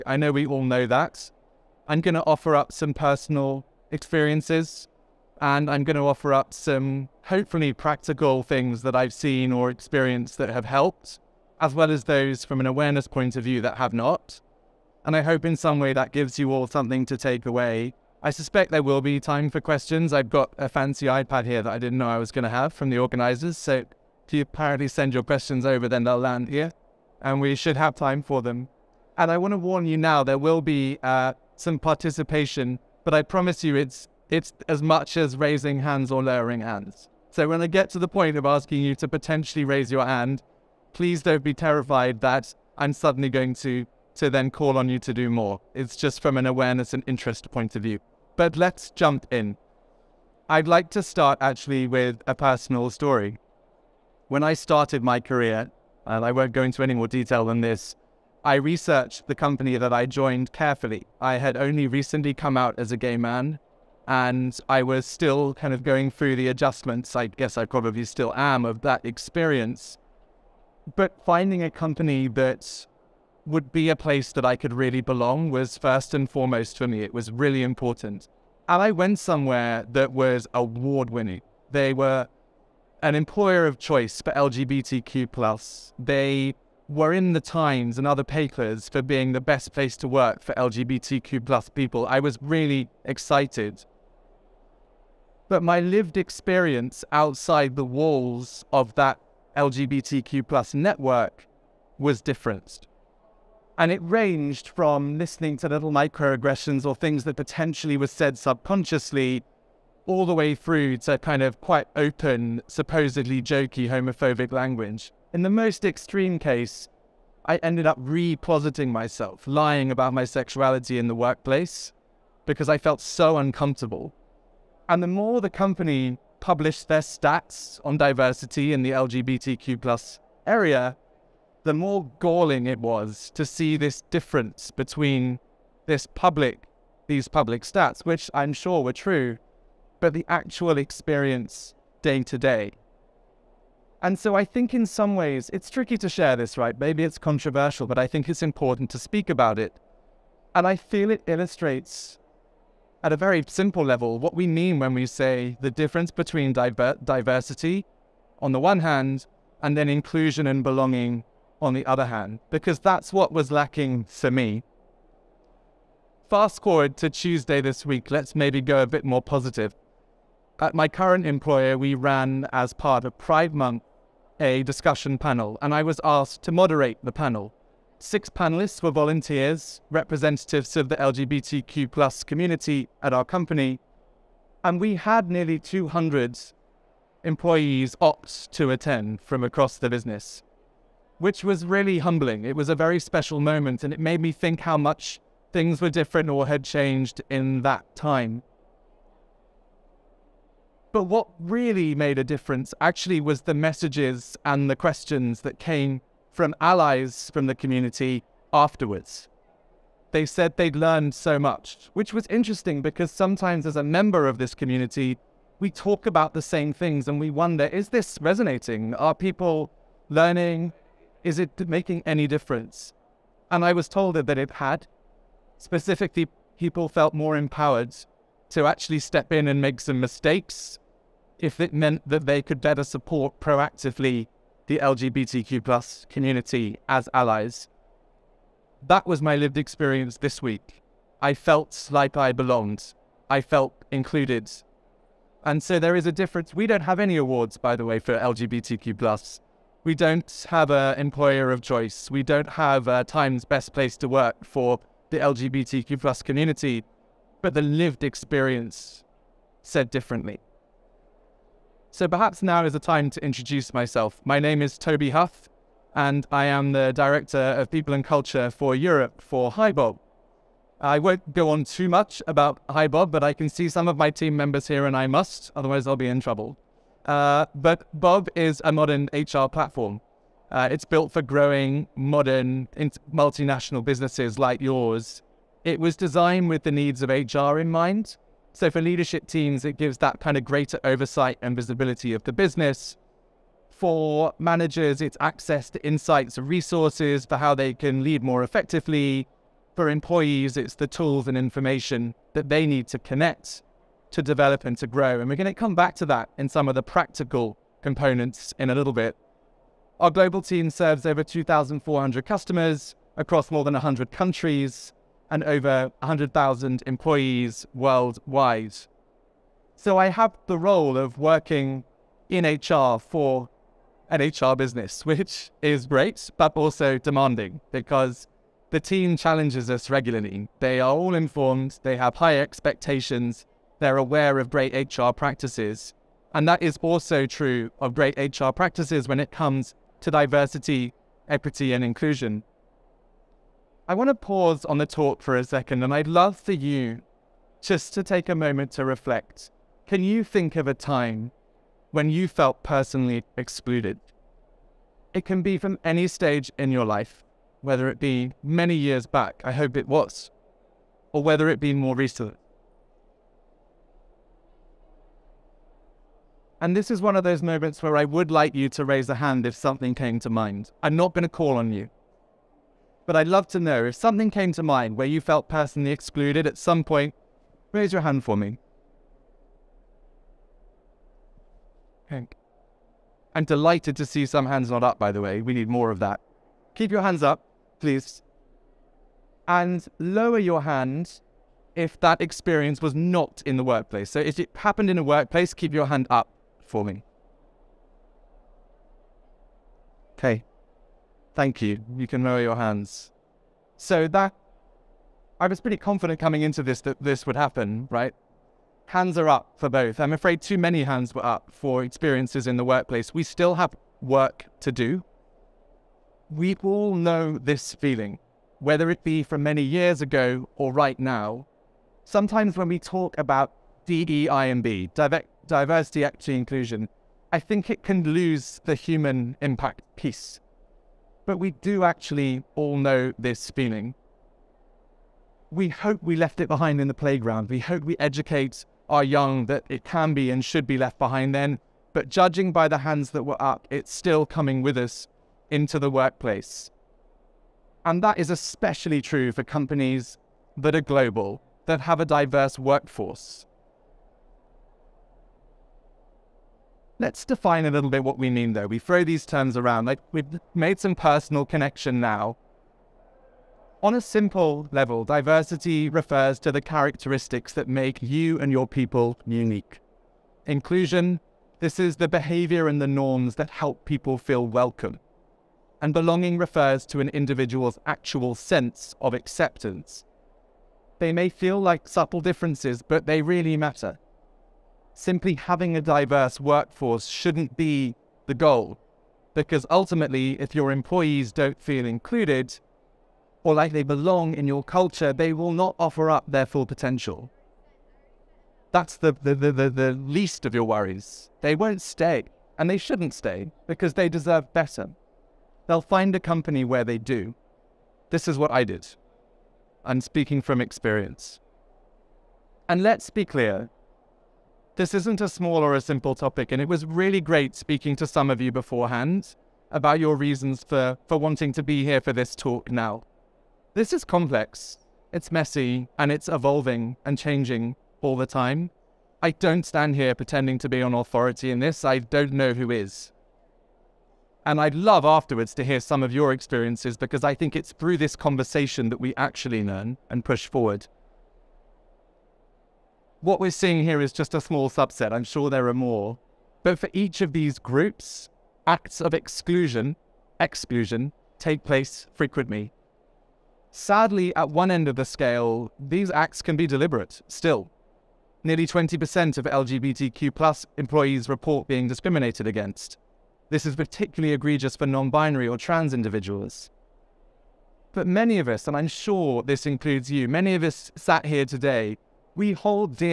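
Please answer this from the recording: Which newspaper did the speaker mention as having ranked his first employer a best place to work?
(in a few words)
The Times.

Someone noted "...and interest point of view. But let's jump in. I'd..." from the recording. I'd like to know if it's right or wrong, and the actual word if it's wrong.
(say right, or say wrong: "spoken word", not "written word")
right.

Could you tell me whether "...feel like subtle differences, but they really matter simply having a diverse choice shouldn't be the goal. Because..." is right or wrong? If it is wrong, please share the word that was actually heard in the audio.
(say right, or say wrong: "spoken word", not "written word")
wrong: "workforce", not "choice".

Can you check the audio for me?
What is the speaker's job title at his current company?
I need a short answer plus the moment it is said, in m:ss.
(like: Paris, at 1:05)
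Director of People and Culture, at 4:26.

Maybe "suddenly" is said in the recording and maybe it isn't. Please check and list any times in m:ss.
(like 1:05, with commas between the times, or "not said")
0:42.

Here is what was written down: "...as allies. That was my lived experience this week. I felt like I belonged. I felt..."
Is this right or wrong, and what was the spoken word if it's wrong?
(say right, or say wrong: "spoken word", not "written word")
right.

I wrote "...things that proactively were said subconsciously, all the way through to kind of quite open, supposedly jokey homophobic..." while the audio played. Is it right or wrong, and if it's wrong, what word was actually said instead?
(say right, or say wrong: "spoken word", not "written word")
wrong: "potentially", not "proactively".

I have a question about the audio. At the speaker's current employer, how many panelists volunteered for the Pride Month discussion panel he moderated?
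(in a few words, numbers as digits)
6.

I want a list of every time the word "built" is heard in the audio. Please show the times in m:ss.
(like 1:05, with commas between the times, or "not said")
4:40.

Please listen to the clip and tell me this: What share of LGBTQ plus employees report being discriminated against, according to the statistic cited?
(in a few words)
20%.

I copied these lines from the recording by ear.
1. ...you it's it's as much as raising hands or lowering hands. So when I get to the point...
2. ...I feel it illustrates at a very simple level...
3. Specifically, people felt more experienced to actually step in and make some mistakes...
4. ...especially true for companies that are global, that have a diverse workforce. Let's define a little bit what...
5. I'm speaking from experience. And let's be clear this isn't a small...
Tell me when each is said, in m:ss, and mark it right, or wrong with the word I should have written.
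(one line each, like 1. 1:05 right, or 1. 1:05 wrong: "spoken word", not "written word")
1. 0:33 right
2. 2:30 right
3. 3:45 wrong: "empowered", not "experienced"
4. 7:28 right
5. 8:29 right.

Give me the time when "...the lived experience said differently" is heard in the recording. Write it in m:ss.
4:17.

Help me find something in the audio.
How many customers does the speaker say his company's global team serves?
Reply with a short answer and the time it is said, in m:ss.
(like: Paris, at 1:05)
2,400, at 5:11.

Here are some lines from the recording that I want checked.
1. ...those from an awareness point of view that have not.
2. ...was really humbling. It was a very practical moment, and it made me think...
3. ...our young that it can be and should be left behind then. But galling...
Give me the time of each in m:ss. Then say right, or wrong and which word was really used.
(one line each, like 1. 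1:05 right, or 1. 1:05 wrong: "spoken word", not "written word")
1. 0:12 right
2. 3:11 wrong: "special", not "practical"
3. 7:18 wrong: "judging", not "galling".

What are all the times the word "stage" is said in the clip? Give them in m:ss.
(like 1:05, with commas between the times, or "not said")
5:56.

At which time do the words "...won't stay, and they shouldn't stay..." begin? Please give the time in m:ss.
8:21.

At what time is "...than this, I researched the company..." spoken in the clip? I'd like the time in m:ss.
0:57.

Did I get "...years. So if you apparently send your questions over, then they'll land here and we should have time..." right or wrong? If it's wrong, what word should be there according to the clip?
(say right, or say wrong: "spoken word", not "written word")
wrong: "organizers", not "years".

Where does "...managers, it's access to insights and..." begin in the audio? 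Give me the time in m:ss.
4:54.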